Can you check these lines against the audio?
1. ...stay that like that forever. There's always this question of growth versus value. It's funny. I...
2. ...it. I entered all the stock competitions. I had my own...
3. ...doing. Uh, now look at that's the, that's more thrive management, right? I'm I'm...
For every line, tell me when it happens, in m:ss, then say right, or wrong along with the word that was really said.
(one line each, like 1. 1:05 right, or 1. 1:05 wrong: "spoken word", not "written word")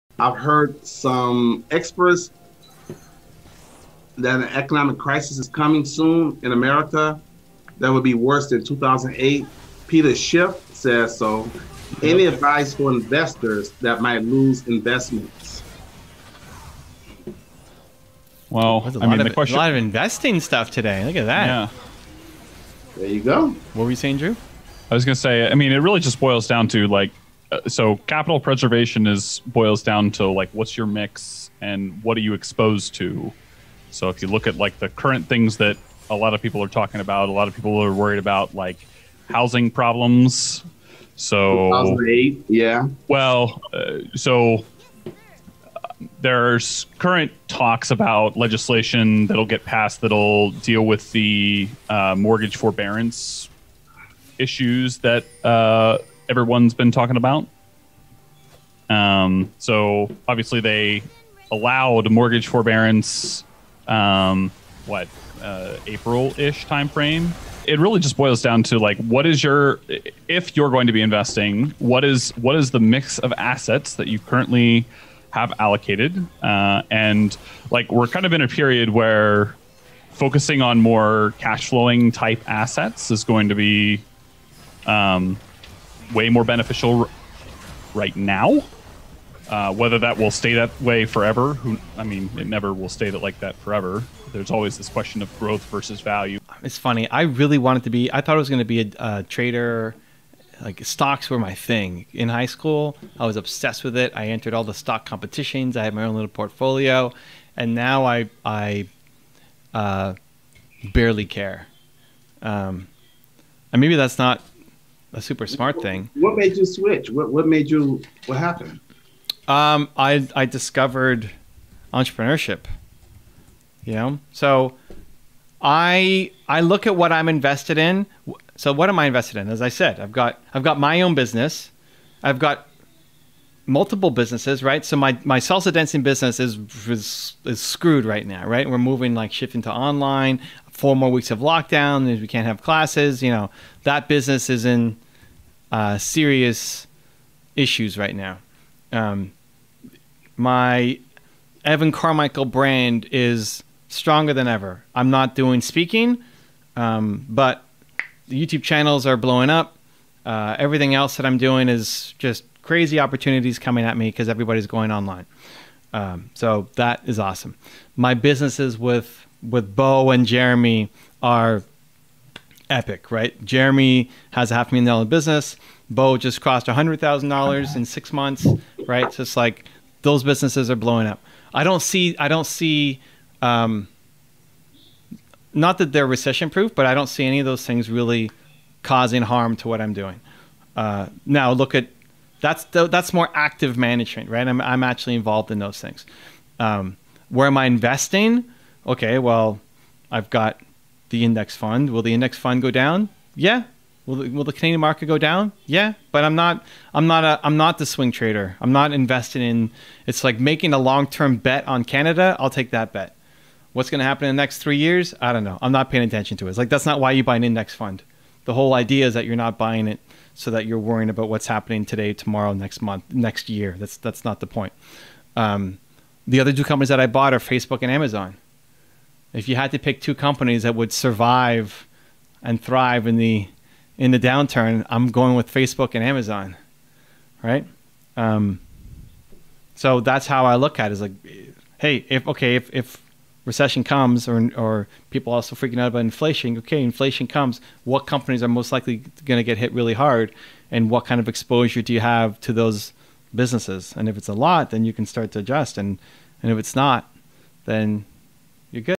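1. 1:32 right
2. 1:43 right
3. 3:09 wrong: "active", not "thrive".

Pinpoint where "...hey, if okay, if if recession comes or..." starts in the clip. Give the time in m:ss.
4:01.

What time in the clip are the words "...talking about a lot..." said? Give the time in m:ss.
0:36.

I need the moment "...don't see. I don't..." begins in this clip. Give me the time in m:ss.
3:01.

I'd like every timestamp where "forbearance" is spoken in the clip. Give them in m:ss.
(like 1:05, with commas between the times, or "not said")
0:52, 1:02.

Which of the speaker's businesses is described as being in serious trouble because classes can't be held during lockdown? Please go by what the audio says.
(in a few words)
salsa dancing business.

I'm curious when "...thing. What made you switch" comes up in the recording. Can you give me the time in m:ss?
1:55.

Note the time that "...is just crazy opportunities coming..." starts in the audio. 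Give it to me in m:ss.
2:41.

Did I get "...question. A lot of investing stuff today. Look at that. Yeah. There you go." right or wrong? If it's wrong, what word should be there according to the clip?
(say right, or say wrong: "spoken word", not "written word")
right.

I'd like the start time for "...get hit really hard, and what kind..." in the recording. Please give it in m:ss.
4:09.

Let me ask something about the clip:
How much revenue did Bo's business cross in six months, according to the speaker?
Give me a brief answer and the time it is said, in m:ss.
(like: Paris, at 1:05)
$100,000, at 2:56.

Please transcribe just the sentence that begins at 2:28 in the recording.
Um, my Evan Carmichael brand is stronger than ever.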